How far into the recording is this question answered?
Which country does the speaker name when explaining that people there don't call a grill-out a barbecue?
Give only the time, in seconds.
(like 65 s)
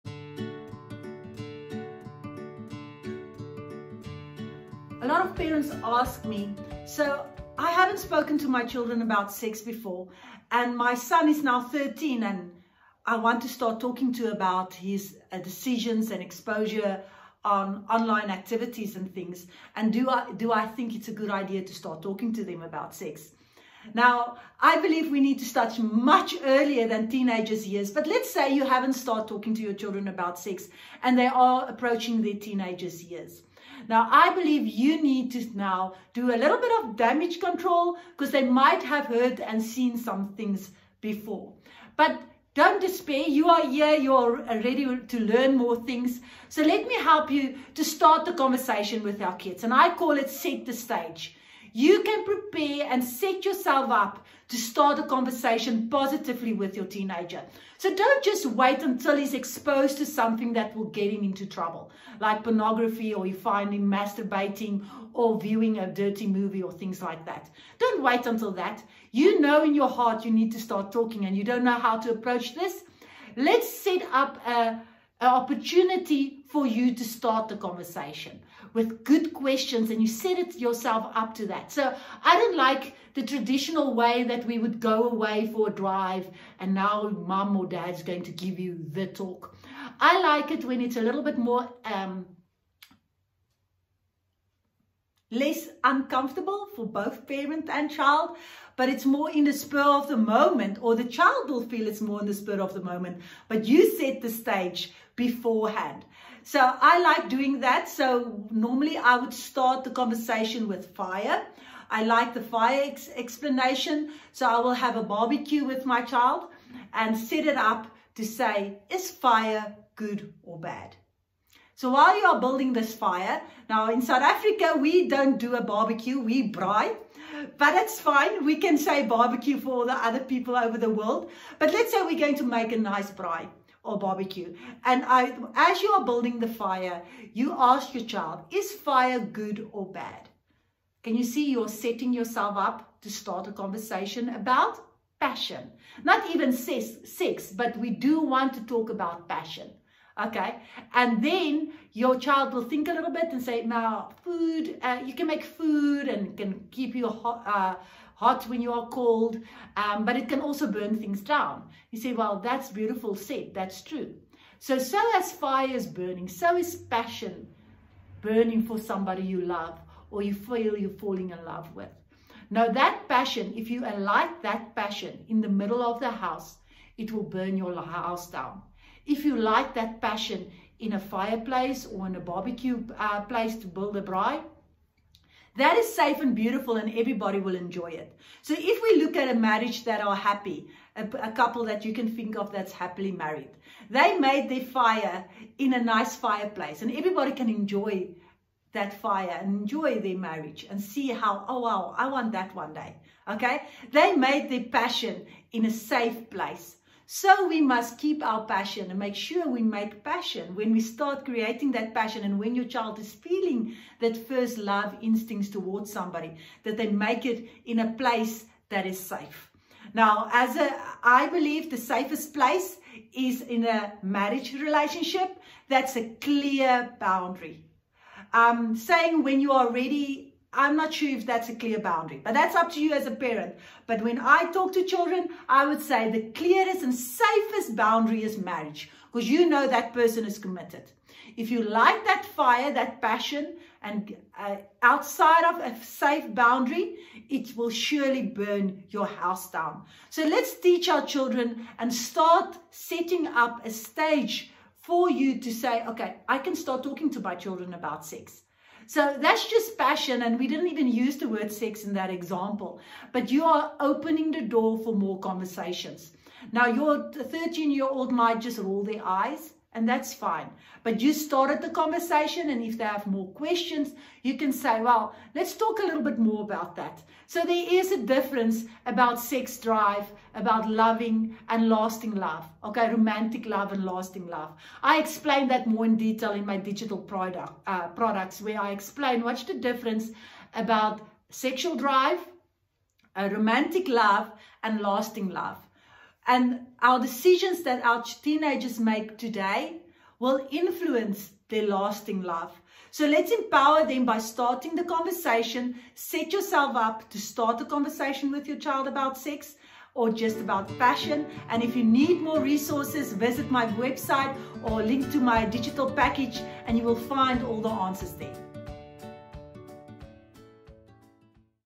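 124 s.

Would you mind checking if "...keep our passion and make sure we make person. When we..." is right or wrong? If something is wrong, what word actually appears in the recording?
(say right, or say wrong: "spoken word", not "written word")
wrong: "passion", not "person".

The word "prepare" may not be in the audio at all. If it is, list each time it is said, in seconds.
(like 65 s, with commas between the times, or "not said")
52 s.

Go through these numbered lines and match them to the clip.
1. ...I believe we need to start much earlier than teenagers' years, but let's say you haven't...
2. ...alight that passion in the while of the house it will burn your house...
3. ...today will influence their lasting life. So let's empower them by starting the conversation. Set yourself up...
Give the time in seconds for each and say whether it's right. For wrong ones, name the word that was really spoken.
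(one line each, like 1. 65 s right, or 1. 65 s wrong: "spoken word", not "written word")
1. 24 s right
2. 173 s wrong: "middle", not "while"
3. 299 s right.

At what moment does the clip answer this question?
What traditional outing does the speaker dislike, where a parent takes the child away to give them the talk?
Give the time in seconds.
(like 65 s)
84 s.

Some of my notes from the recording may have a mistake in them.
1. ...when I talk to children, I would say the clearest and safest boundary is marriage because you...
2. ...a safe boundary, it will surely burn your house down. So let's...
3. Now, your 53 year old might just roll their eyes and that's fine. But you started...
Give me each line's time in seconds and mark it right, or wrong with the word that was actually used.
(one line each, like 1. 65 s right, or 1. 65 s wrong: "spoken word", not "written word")
1. 234 s right
2. 245 s right
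3. 266 s wrong: "13", not "53".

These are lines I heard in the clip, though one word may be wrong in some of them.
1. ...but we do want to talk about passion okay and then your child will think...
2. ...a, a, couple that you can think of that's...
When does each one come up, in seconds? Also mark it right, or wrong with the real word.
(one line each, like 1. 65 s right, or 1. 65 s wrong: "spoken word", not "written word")
1. 147 s right
2. 190 s right.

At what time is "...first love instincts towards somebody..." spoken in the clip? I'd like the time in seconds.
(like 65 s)
214 s.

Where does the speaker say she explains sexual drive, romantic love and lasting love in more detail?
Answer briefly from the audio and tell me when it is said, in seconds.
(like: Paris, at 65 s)
digital product, at 286 s.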